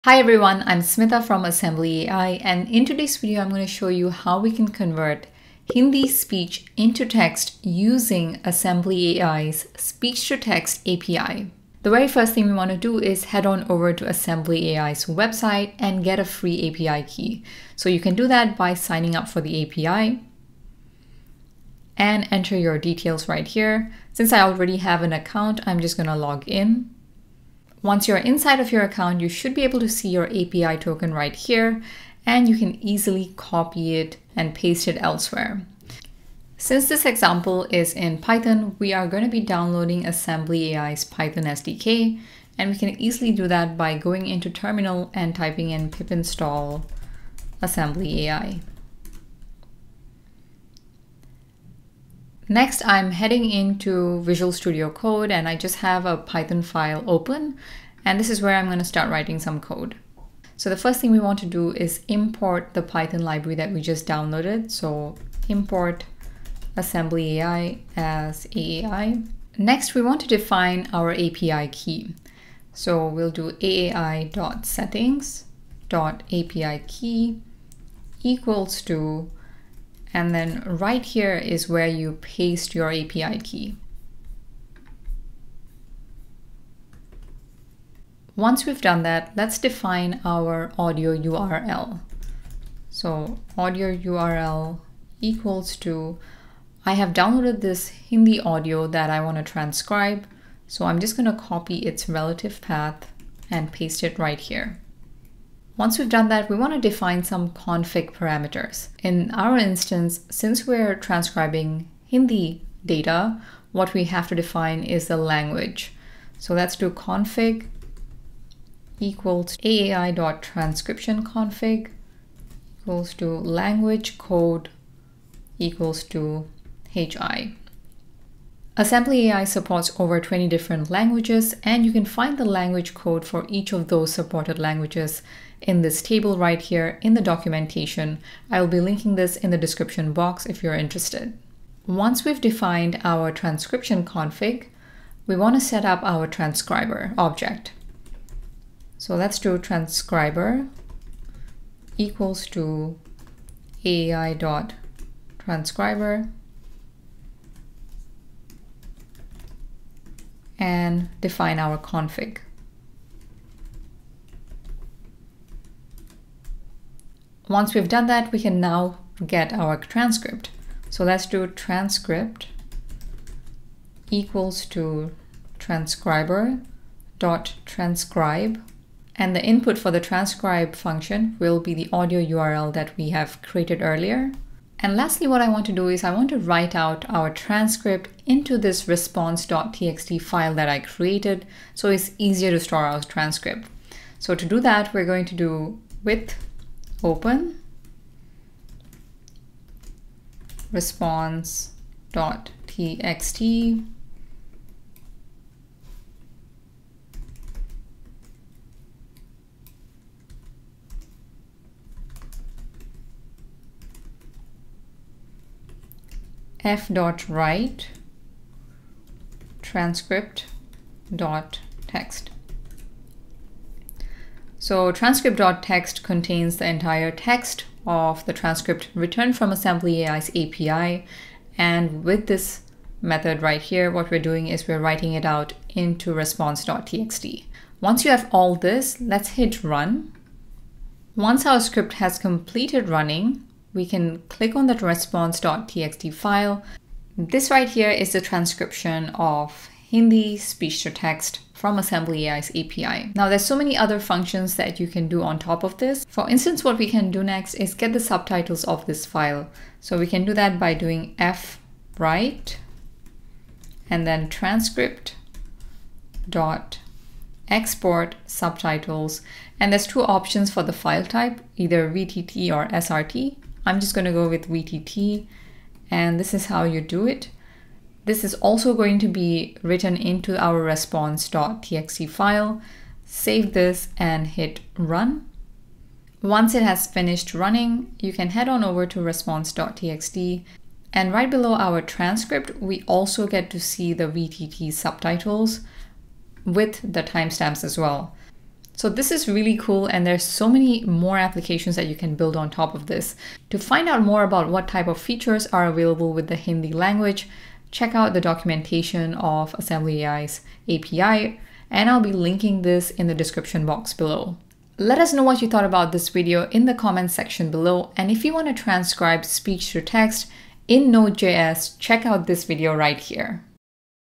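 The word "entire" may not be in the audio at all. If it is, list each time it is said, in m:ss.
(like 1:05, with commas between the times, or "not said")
3:46.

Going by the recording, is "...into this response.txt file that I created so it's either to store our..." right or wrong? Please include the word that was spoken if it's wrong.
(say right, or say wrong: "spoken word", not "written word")
wrong: "easier", not "either".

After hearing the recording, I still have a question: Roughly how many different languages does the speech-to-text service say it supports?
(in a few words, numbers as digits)
over 20.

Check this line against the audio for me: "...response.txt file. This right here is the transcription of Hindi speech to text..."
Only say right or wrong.
right.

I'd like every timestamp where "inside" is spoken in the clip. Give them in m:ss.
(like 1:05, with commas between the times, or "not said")
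0:28.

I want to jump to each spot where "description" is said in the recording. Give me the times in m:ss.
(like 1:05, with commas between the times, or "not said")
2:19, 5:13.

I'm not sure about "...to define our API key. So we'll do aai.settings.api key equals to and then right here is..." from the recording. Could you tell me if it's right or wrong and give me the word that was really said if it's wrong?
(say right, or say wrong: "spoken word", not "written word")
right.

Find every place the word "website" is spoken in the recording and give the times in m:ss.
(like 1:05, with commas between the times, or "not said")
0:15.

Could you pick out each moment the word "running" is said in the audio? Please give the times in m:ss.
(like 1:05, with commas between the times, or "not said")
4:02, 4:47.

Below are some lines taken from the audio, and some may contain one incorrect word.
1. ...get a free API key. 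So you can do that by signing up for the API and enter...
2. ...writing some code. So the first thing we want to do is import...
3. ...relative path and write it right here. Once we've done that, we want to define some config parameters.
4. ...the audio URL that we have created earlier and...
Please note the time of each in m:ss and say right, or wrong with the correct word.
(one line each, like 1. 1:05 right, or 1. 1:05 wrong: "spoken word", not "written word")
1. 0:16 right
2. 0:59 right
3. 1:42 wrong: "paste", not "write"
4. 3:01 right.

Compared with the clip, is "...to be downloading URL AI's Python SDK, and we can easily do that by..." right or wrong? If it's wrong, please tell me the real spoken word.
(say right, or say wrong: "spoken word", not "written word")
wrong: "Assembly", not "URL".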